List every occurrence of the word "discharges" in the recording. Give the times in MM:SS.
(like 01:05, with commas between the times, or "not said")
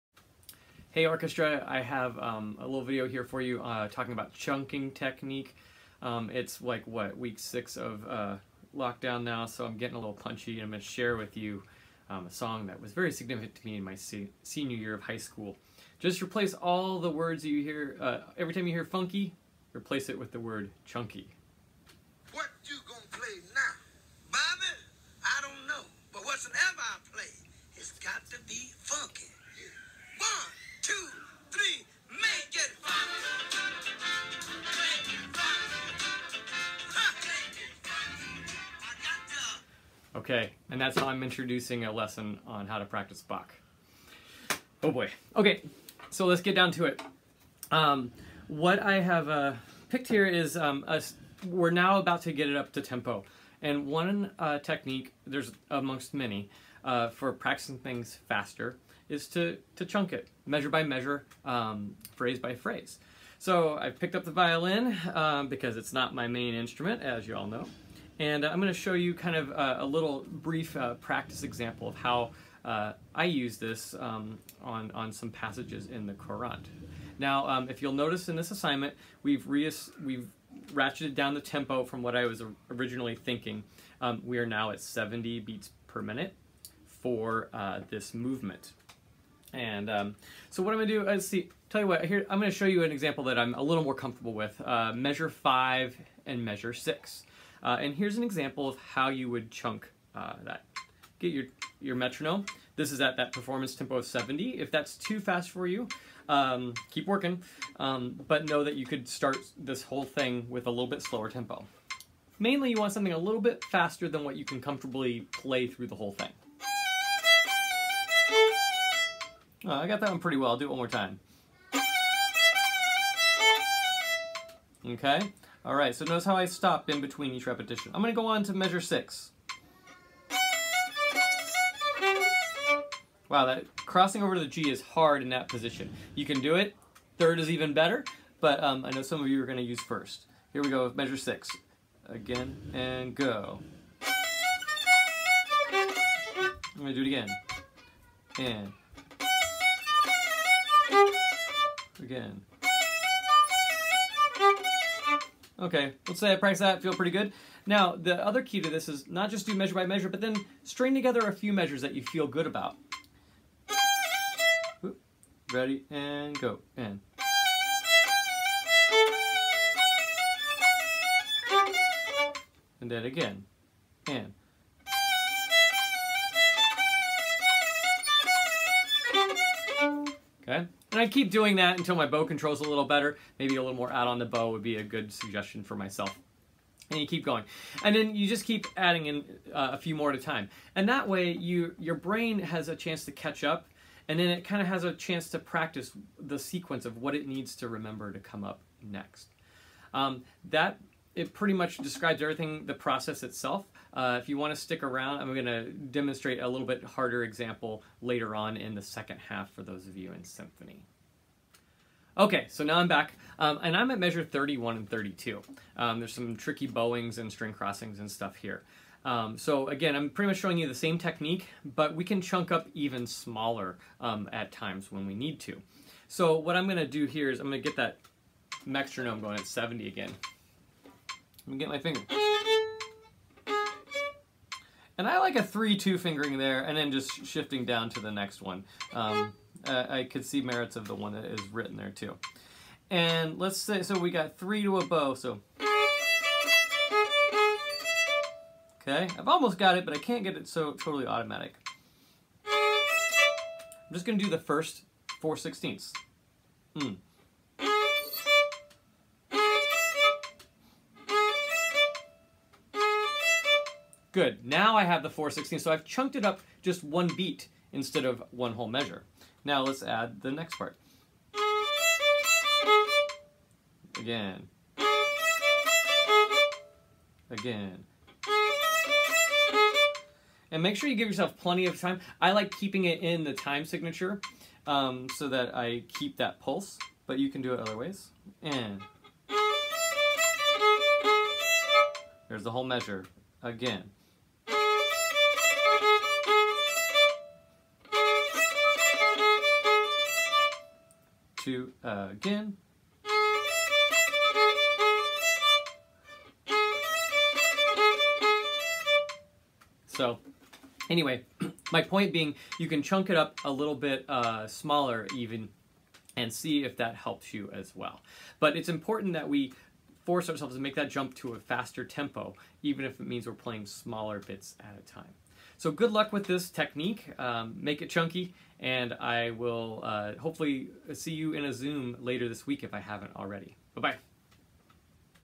not said.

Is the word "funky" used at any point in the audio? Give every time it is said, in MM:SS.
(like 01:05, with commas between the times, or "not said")
00:18, 00:28.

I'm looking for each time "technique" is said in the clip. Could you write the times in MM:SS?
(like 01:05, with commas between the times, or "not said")
00:04, 00:54, 03:40, 05:26.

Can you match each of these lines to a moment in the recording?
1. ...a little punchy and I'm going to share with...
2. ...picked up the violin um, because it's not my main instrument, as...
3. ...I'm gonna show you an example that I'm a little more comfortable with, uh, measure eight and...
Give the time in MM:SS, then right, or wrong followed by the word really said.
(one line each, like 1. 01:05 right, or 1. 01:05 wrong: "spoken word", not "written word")
1. 00:09 right
2. 01:03 right
3. 01:32 wrong: "five", not "eight".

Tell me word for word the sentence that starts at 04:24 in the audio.
Now I have the 416, so I've chunked it up just one beat instead of one whole measure.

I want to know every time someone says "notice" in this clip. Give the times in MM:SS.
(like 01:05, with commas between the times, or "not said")
01:17, 02:06.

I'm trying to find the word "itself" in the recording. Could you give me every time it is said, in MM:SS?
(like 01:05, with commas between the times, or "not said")
03:23.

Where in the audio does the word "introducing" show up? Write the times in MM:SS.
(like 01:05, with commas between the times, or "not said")
00:41.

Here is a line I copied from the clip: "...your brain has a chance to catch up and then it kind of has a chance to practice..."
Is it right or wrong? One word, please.
right.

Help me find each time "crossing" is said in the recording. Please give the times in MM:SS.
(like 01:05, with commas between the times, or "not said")
02:13, 03:37.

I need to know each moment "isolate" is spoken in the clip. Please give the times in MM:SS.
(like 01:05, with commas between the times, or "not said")
not said.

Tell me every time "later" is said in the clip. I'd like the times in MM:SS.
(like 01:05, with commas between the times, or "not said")
03:28, 05:31.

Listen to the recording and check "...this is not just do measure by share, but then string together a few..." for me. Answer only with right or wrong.
wrong.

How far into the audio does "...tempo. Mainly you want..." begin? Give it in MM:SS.
01:51.